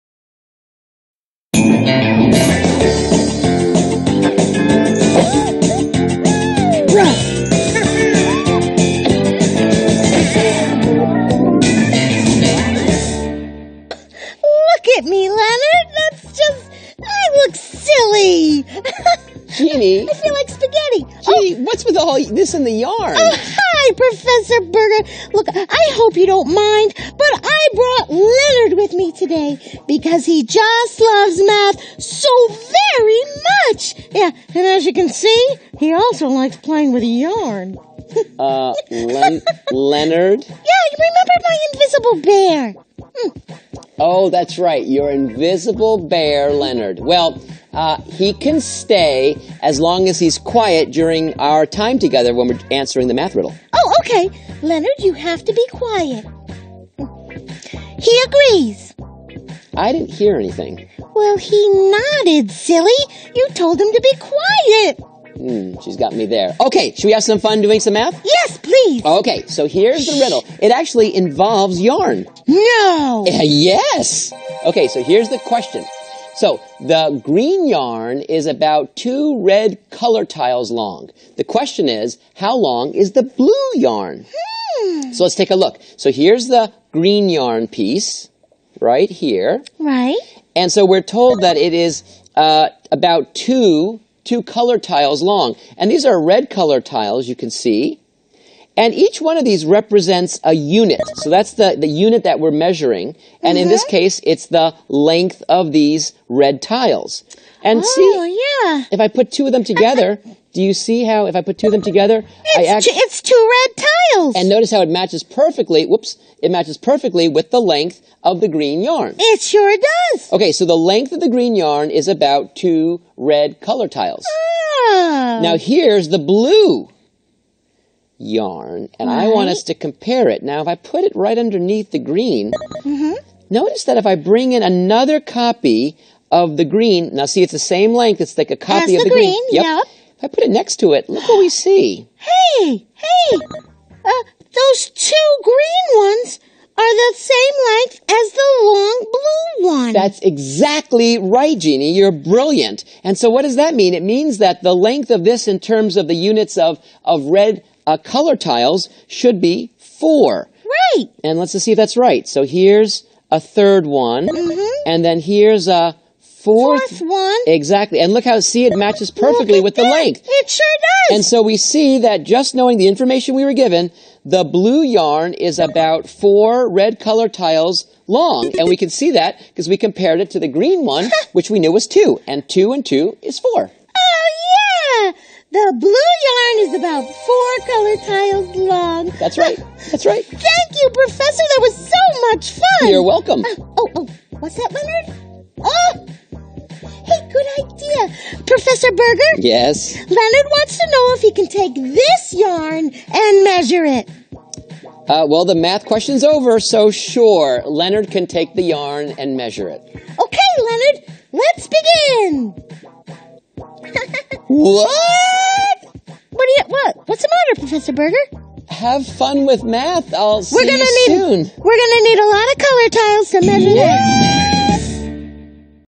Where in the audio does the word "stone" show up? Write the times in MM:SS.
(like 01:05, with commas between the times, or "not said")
not said.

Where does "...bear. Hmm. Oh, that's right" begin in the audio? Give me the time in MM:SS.
00:42.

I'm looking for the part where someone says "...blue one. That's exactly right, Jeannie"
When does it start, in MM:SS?
02:29.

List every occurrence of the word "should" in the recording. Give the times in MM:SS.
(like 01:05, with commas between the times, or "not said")
01:06, 02:39.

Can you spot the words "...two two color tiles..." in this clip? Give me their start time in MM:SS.
01:33.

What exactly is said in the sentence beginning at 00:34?
Yeah, and as you can see, he also likes playing with yarn.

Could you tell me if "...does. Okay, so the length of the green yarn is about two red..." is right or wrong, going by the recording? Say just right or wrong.
right.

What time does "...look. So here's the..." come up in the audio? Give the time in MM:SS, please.
01:25.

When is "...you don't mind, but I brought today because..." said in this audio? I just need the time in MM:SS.
00:26.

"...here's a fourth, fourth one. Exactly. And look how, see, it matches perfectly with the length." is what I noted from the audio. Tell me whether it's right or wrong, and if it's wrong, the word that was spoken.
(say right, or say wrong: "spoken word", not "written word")
right.